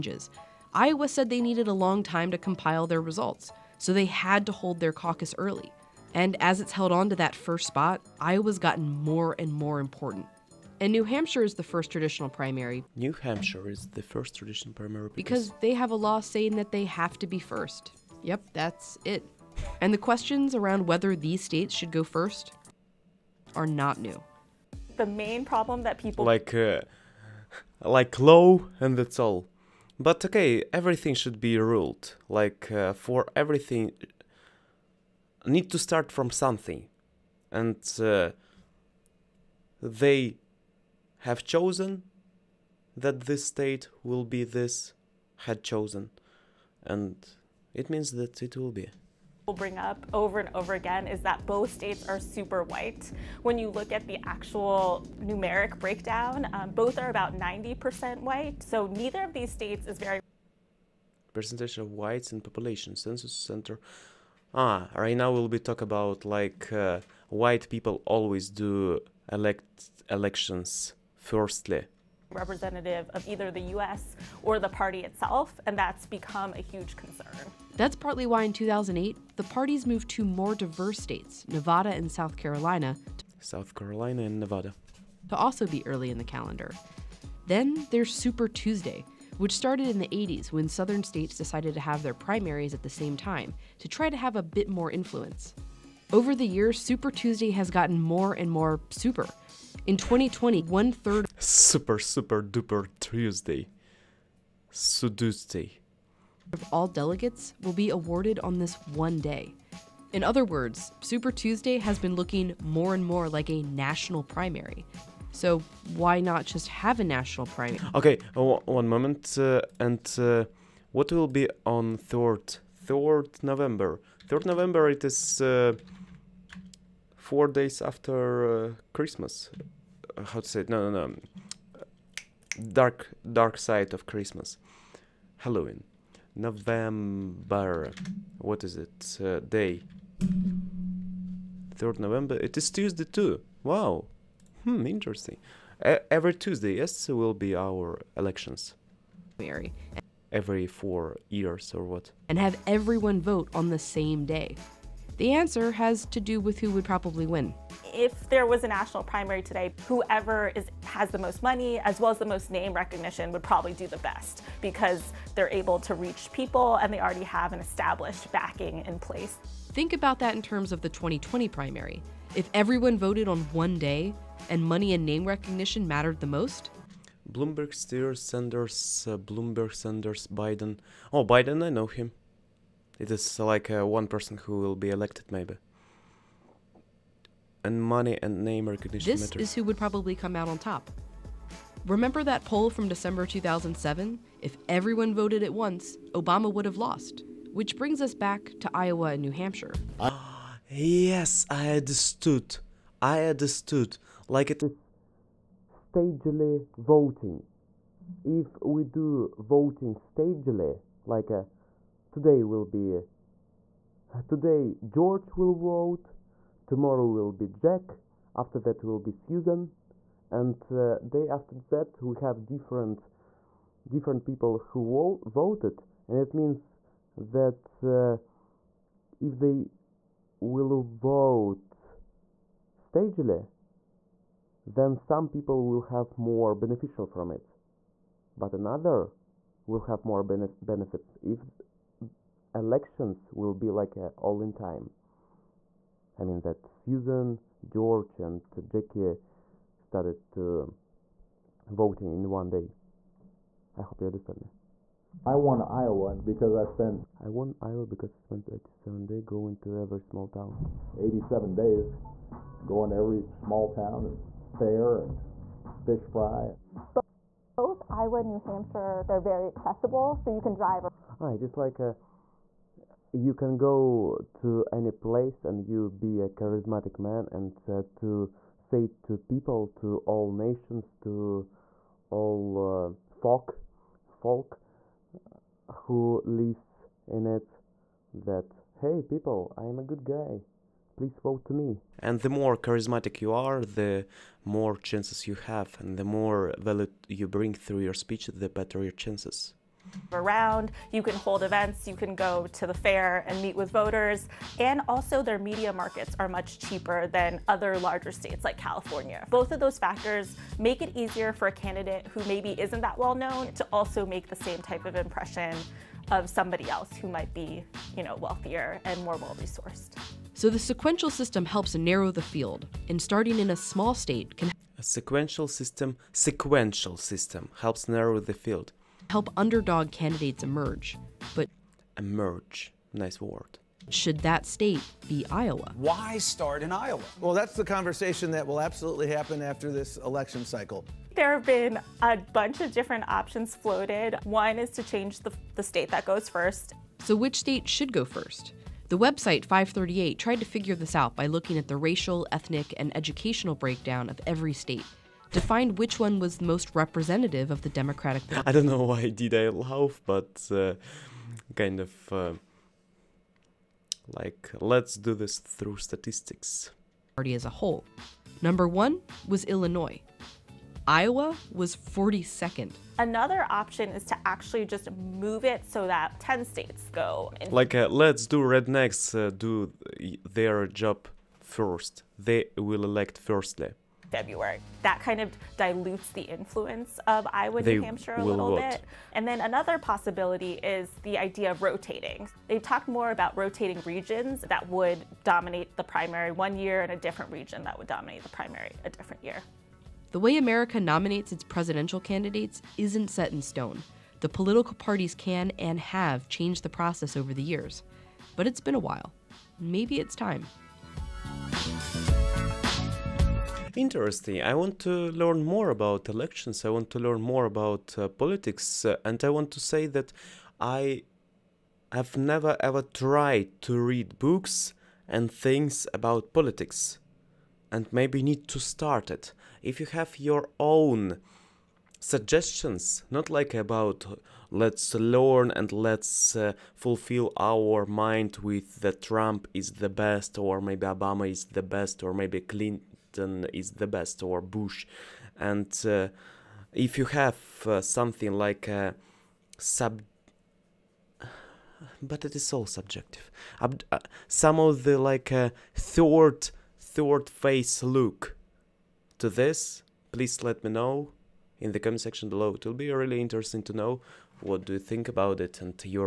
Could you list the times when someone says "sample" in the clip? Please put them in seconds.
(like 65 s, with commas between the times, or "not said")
not said.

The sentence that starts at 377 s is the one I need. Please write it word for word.
like, uh, let's do rednecks uh, do their job first.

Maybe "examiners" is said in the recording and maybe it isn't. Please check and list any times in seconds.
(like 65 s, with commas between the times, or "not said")
not said.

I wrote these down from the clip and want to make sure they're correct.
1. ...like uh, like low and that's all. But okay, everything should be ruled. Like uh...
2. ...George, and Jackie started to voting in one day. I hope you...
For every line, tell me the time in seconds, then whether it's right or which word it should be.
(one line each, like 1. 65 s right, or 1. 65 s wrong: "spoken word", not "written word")
1. 26 s right
2. 247 s right.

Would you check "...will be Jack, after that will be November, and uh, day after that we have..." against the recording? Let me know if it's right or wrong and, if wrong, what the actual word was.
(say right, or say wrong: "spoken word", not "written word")
wrong: "Susan", not "November".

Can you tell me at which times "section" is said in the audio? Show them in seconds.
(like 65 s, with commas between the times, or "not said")
461 s.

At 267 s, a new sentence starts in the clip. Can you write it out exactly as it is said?
Both Iowa and New Hampshire, they're very accessible, so you can drive.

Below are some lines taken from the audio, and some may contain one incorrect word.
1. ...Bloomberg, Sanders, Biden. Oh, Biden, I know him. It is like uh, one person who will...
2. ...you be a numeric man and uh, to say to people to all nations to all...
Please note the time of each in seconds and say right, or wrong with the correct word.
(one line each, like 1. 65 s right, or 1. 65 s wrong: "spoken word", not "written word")
1. 179 s right
2. 275 s wrong: "charismatic", not "numeric".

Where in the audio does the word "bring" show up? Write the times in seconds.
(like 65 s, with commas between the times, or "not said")
49 s, 197 s, 297 s.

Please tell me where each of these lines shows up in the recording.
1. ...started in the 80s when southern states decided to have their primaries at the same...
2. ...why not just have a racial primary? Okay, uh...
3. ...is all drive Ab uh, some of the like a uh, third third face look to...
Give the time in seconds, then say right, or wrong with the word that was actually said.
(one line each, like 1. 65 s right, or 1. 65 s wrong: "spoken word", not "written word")
1. 89 s right
2. 115 s wrong: "national", not "racial"
3. 452 s wrong: "subjective", not "drive".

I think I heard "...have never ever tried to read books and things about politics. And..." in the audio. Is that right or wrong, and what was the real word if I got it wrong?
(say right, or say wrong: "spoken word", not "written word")
right.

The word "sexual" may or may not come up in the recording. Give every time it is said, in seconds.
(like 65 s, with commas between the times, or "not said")
not said.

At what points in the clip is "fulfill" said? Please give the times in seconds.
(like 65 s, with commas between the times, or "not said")
436 s.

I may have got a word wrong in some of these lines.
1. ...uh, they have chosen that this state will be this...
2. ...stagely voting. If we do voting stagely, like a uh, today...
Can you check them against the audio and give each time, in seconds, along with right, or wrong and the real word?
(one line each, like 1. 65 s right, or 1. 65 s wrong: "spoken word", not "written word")
1. 38 s right
2. 205 s right.